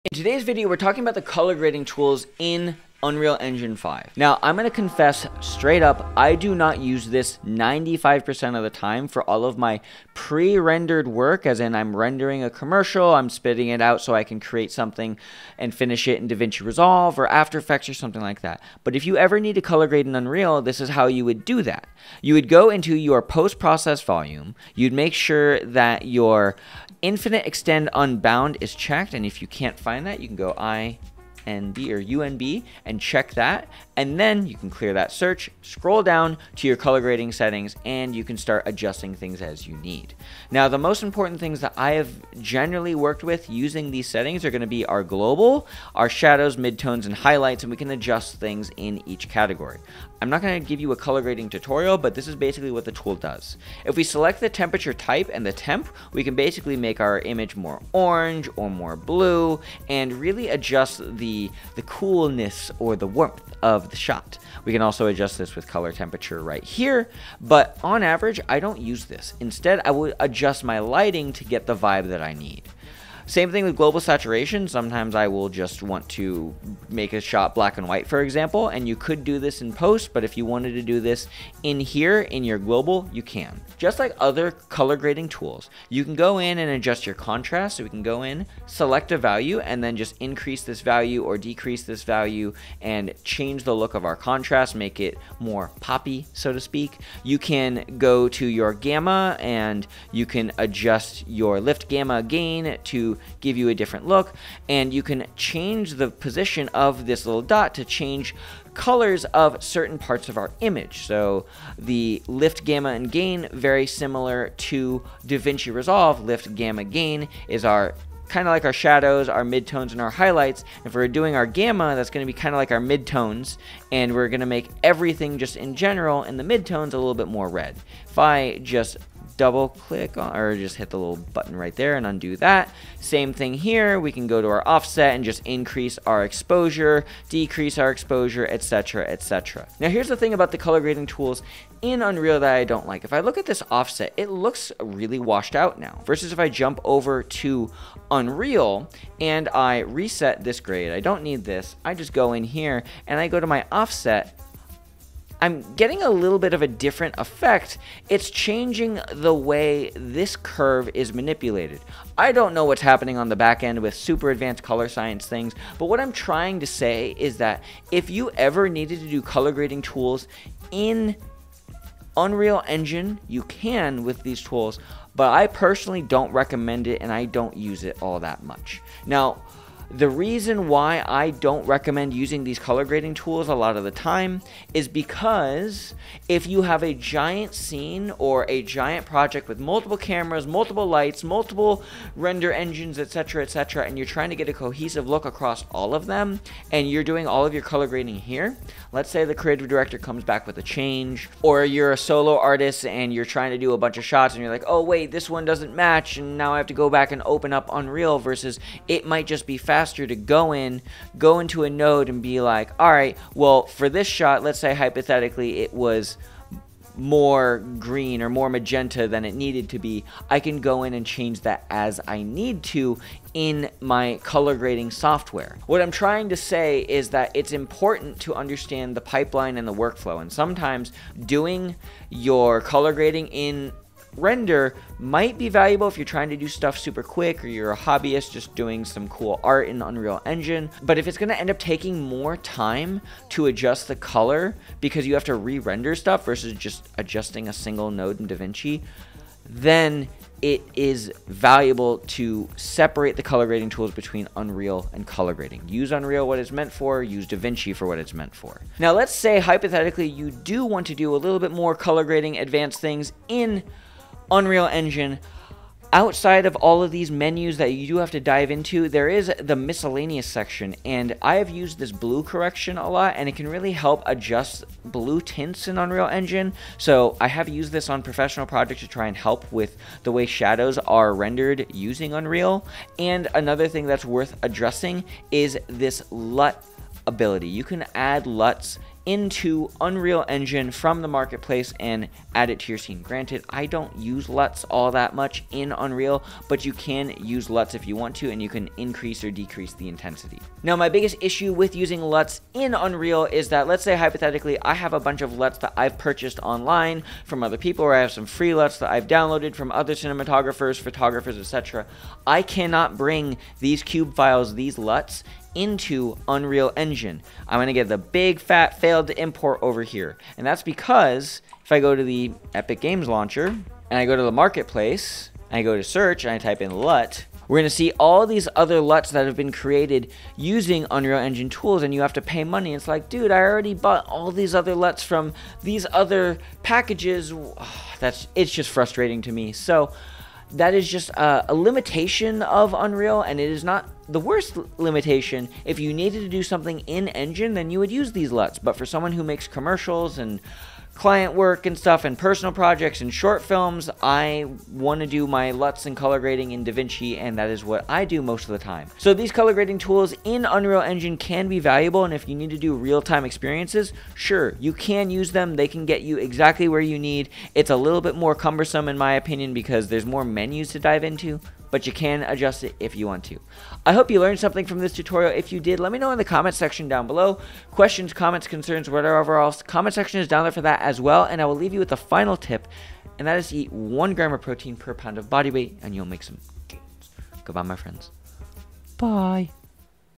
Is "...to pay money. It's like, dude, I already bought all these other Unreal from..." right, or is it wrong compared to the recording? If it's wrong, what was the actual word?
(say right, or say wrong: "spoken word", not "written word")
wrong: "LUTs", not "Unreal".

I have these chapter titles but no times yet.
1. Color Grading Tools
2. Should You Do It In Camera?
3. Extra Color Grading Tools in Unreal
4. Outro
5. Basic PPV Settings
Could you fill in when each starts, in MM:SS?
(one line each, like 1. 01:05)
1. 00:53
2. 02:19
3. 04:18
4. 06:13
5. 00:26.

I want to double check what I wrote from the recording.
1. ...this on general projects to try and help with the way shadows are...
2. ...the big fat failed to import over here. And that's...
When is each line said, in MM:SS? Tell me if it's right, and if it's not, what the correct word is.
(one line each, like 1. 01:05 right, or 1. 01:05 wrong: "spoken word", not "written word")
1. 04:37 wrong: "professional", not "general"
2. 05:17 right.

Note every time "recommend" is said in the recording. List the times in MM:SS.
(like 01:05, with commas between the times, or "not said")
02:56, 03:01.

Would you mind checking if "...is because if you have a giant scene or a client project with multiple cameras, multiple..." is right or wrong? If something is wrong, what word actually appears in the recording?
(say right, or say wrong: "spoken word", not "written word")
wrong: "giant", not "client".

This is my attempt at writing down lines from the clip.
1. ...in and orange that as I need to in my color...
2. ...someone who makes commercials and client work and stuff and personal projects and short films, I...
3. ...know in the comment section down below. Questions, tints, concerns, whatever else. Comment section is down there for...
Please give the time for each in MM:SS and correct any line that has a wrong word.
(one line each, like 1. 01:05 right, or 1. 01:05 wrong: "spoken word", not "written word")
1. 03:40 wrong: "change", not "orange"
2. 05:48 right
3. 06:15 wrong: "comments", not "tints".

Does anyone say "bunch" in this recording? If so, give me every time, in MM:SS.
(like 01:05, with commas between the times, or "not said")
03:23, 05:04.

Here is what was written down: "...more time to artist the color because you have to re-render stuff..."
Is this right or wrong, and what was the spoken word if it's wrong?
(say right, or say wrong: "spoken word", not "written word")
wrong: "adjust", not "artist".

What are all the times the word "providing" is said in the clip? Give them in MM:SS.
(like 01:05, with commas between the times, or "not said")
not said.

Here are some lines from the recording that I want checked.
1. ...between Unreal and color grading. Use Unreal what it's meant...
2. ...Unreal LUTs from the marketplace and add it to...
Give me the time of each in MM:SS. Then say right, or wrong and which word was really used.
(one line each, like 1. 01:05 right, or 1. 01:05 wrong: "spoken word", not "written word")
1. 04:13 right
2. 04:49 wrong: "Engine", not "LUTs".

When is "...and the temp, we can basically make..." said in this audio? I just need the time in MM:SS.
00:55.